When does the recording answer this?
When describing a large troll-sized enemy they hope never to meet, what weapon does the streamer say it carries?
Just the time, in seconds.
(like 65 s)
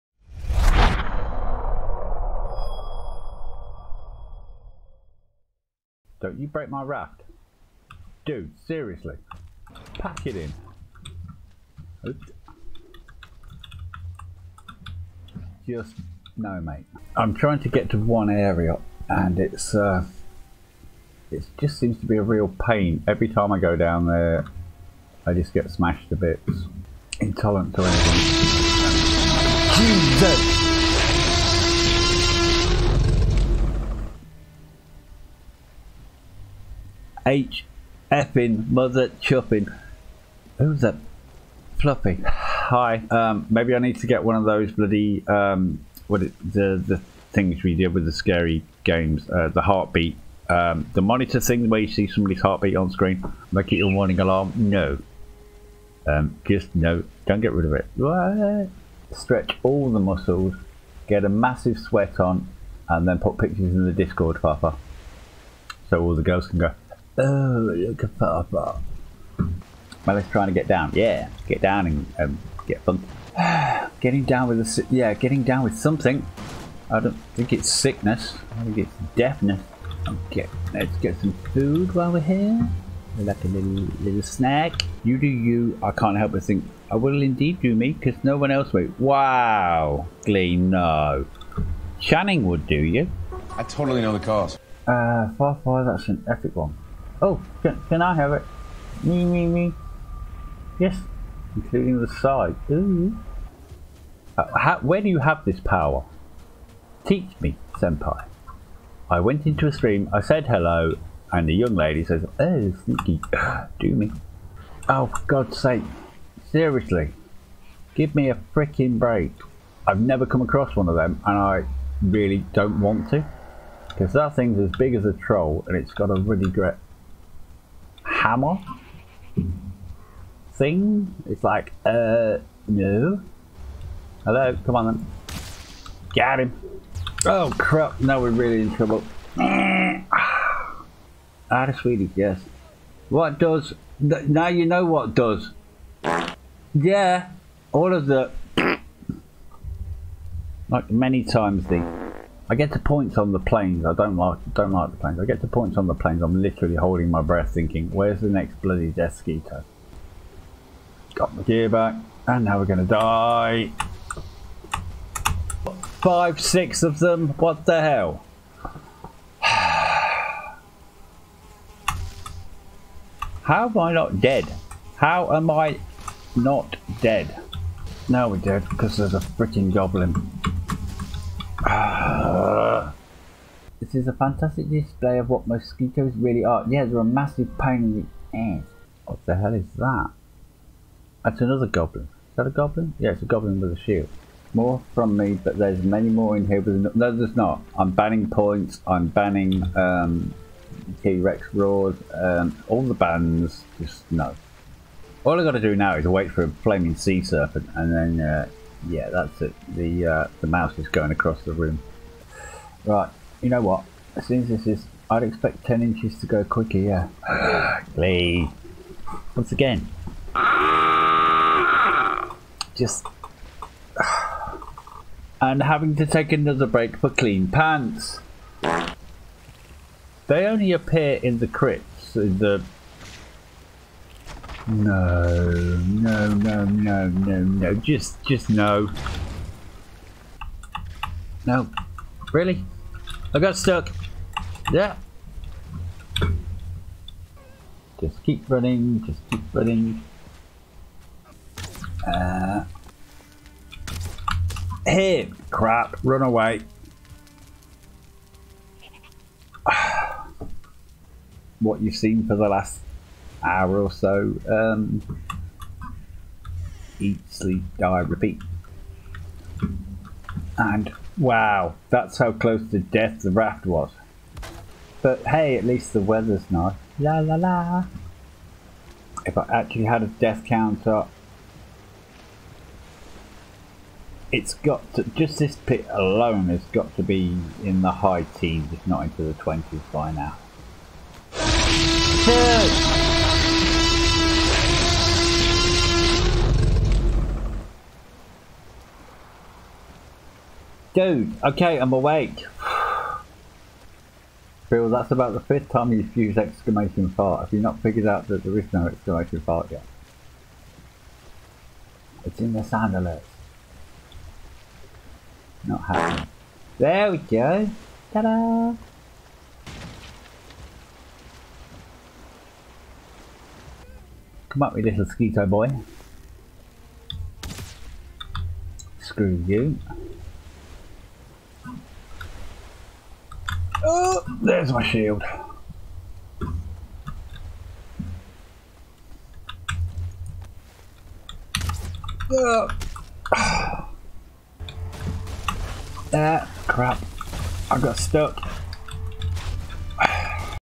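128 s.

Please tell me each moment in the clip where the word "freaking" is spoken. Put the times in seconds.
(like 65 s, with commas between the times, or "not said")
118 s, 179 s.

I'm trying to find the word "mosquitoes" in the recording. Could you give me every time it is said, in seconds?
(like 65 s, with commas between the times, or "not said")
185 s.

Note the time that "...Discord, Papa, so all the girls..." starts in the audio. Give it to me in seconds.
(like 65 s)
63 s.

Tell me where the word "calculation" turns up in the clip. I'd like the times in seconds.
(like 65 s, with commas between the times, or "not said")
not said.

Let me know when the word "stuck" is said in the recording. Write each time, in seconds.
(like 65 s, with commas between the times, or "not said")
243 s, 347 s.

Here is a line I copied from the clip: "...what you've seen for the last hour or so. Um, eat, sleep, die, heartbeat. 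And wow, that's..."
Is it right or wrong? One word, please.
wrong.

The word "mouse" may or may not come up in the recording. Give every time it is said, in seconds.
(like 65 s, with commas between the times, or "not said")
210 s.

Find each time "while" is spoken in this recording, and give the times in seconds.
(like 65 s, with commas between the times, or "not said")
81 s.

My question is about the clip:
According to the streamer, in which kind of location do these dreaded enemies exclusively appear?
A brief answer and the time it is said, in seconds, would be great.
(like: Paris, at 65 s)
the crypts, at 231 s.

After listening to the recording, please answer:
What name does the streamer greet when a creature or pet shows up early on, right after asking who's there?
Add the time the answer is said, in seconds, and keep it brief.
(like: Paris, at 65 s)
Fluffy, at 41 s.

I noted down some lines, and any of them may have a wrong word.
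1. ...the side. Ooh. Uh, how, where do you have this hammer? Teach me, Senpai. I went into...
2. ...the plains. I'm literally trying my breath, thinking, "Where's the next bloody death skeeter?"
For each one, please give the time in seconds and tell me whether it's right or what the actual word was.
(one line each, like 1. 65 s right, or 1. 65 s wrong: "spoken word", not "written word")
1. 102 s wrong: "power", not "hammer"
2. 155 s wrong: "holding", not "trying".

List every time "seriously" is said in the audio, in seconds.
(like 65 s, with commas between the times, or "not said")
8 s, 116 s.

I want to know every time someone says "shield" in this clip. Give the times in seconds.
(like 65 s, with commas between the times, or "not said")
193 s, 334 s.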